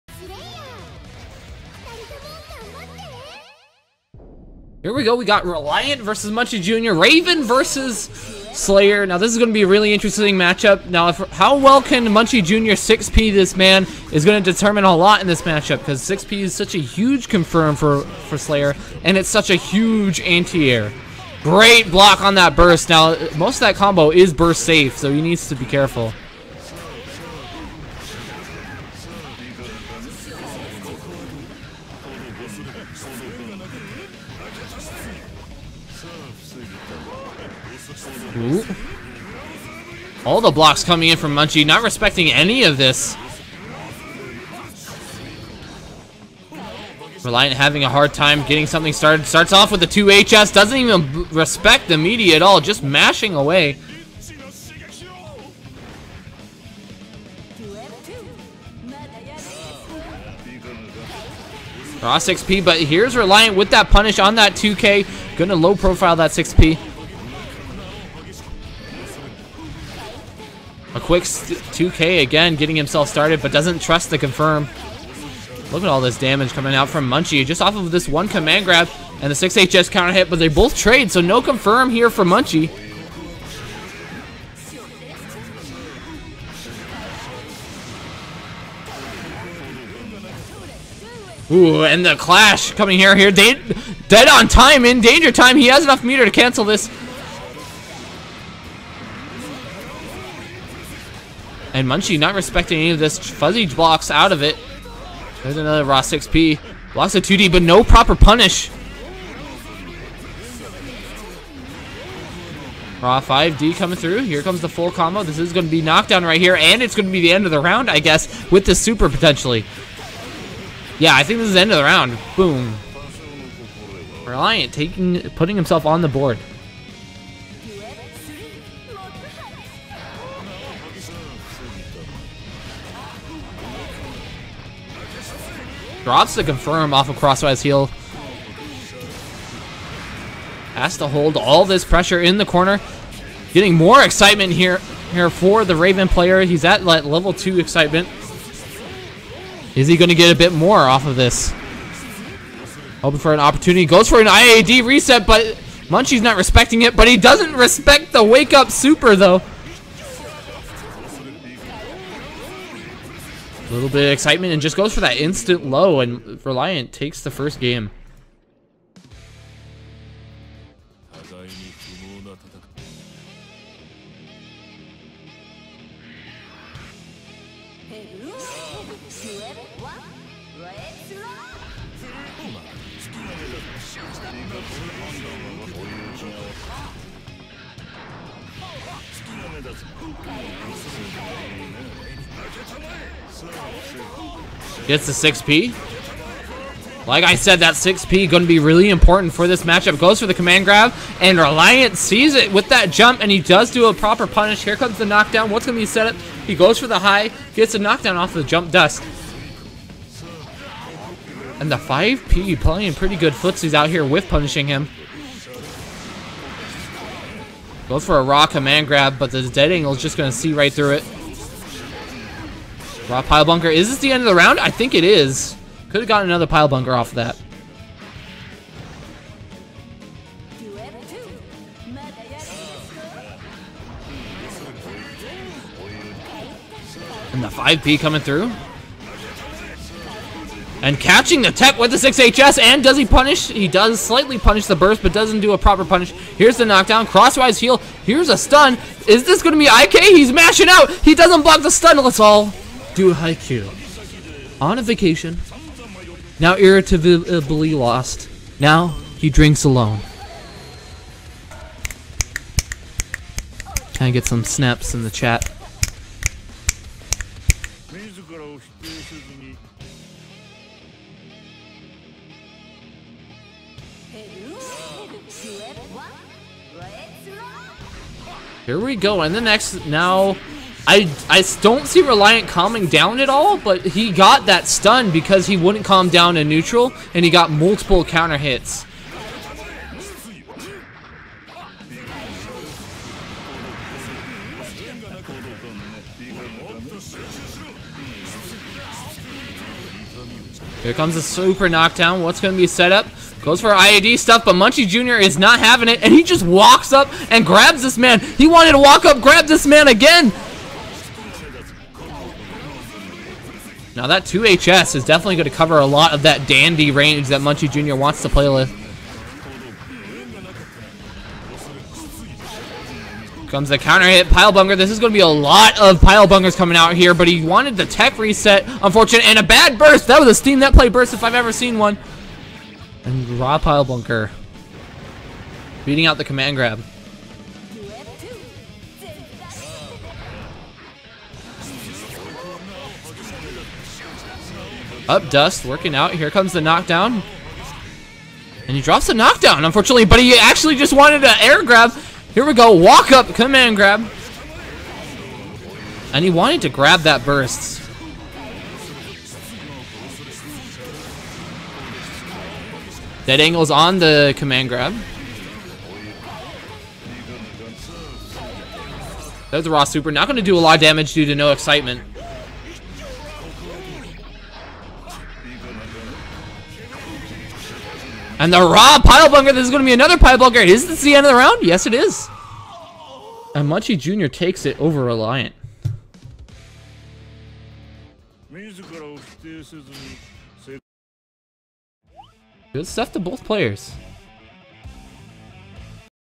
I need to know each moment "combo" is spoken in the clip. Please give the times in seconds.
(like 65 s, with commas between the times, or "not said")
23 s, 114 s.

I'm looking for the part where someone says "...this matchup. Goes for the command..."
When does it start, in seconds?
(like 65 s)
199 s.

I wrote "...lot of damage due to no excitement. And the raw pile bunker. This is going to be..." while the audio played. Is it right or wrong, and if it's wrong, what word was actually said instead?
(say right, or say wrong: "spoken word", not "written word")
right.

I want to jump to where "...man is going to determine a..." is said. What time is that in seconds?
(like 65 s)
13 s.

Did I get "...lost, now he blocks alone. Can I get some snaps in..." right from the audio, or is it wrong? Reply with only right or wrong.
wrong.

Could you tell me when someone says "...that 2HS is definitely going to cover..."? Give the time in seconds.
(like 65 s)
314 s.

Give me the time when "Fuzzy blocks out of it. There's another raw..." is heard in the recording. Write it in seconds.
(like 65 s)
103 s.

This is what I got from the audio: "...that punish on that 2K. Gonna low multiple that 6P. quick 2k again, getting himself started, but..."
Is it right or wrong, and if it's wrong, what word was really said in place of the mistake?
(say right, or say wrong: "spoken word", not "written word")
wrong: "profile", not "multiple".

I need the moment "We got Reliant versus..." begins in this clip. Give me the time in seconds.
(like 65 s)
5 s.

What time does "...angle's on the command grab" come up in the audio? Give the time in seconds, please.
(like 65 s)
363 s.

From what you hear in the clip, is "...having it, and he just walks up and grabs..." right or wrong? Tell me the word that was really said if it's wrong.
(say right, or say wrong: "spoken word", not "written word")
right.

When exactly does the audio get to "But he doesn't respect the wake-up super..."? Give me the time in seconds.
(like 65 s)
156 s.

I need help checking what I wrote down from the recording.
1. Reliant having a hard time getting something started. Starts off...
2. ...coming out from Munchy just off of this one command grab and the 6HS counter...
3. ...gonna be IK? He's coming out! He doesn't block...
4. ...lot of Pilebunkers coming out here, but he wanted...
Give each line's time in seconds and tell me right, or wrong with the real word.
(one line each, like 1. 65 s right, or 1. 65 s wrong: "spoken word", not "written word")
1. 47 s right
2. 76 s right
3. 249 s wrong: "mashing", not "coming"
4. 325 s right.